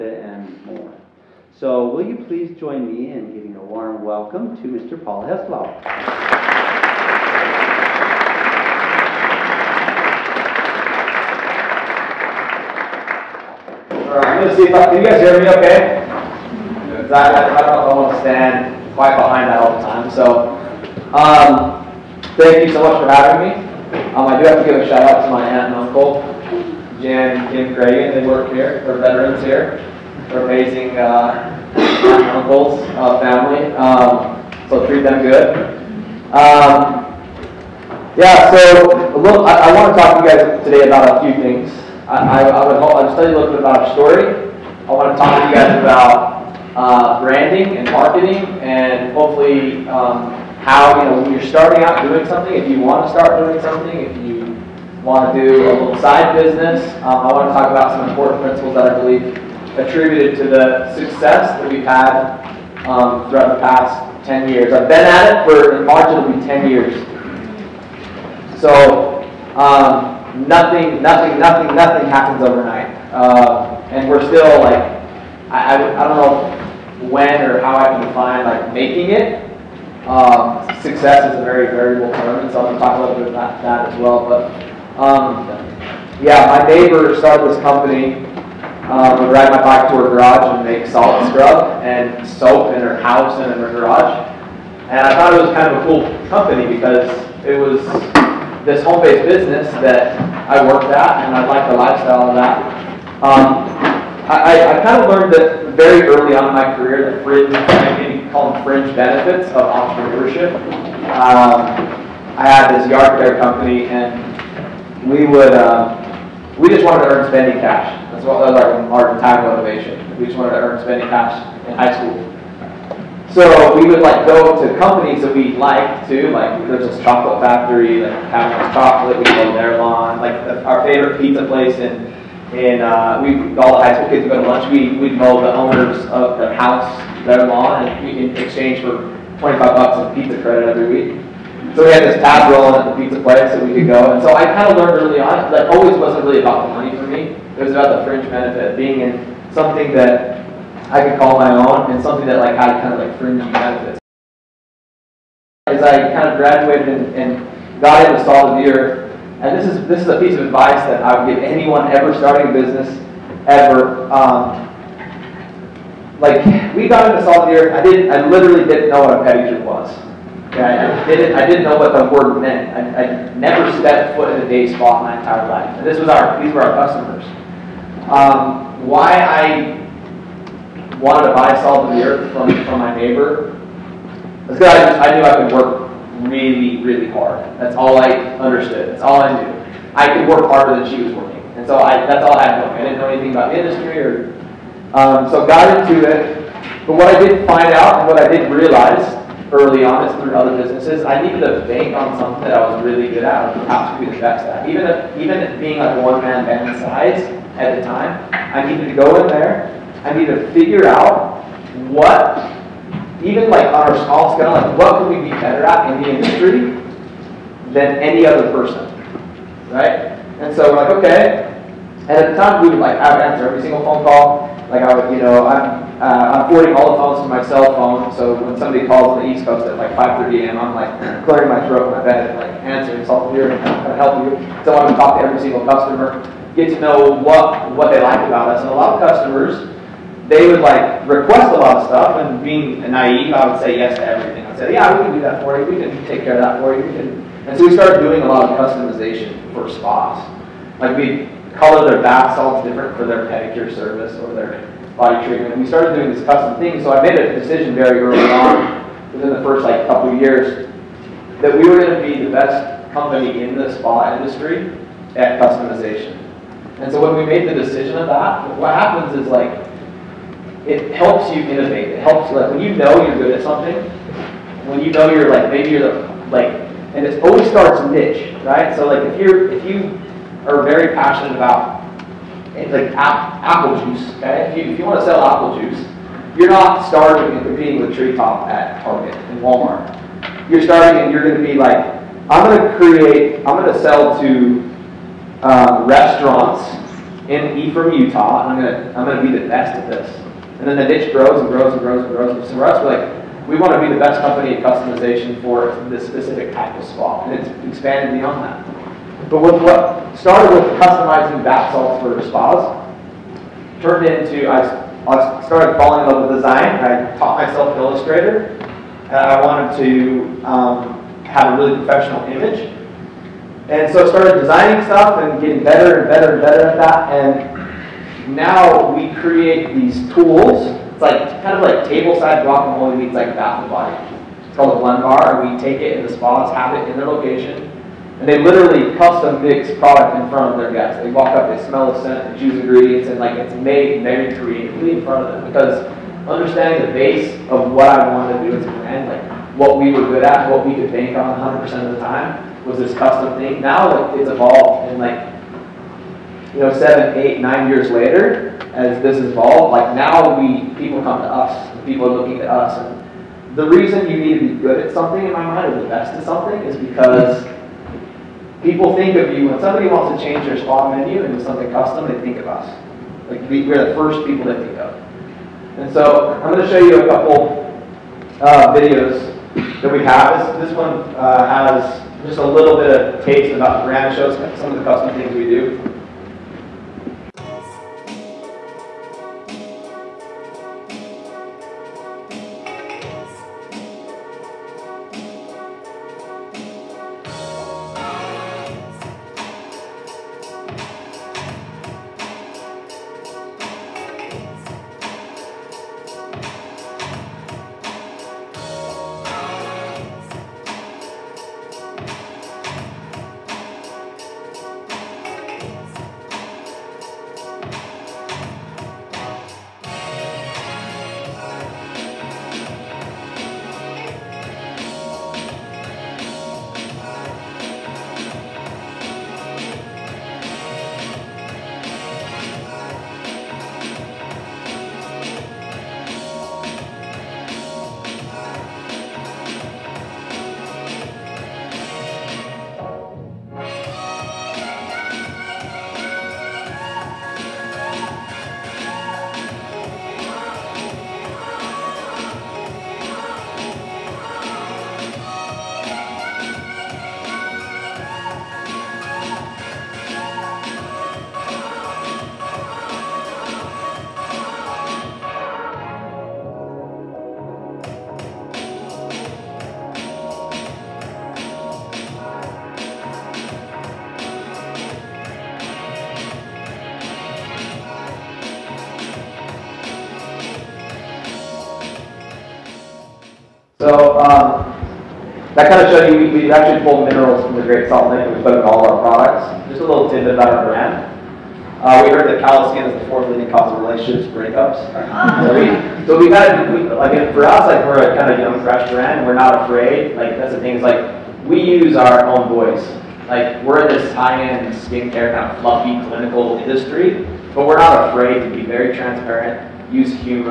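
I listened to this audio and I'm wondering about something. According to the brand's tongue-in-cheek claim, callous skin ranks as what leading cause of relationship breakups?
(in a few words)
fourth.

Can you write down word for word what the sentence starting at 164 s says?
Um, like, we got into Salt of the Earth, I didn't, I literally didn't know what a pedicure was.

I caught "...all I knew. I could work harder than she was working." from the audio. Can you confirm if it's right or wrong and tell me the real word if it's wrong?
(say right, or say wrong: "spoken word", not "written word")
right.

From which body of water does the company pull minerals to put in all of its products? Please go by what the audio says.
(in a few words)
Great Salt Lake.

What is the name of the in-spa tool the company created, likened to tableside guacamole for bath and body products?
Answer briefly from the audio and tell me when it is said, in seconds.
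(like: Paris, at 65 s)
blend bar, at 334 s.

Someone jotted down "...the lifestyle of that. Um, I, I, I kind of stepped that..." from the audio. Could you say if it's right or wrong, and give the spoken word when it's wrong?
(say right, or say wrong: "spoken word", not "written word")
wrong: "learned", not "stepped".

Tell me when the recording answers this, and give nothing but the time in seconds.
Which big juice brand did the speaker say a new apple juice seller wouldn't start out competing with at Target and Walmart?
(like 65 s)
287 s.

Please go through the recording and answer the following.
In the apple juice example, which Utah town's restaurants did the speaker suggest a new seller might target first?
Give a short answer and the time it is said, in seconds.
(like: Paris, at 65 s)
Ephraim, at 297 s.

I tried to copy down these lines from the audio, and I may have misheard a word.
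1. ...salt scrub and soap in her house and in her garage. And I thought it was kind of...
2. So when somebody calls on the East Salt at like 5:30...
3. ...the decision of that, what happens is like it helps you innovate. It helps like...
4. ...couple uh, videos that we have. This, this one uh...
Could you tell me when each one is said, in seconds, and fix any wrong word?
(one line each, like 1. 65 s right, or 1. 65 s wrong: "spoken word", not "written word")
1. 90 s right
2. 228 s wrong: "Coast", not "Salt"
3. 267 s right
4. 377 s right.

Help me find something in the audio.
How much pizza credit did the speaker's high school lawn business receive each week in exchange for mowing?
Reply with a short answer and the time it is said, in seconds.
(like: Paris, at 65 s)
$25, at 139 s.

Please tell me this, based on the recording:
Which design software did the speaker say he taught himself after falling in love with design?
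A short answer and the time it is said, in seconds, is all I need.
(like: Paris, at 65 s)
Illustrator, at 317 s.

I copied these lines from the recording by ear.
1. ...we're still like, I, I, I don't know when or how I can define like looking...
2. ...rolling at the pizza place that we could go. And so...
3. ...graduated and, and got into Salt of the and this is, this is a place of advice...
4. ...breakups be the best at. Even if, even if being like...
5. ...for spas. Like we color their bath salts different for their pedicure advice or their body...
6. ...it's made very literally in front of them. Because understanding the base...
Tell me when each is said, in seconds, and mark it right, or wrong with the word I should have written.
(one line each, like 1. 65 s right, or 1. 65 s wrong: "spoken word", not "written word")
1. 74 s wrong: "making", not "looking"
2. 142 s right
3. 156 s wrong: "piece", not "place"
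4. 203 s wrong: "perhaps", not "breakups"
5. 249 s wrong: "service", not "advice"
6. 343 s wrong: "creatively", not "literally".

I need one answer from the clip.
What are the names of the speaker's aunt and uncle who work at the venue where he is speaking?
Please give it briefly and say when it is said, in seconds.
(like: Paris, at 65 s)
Jan and Kim Gray, at 27 s.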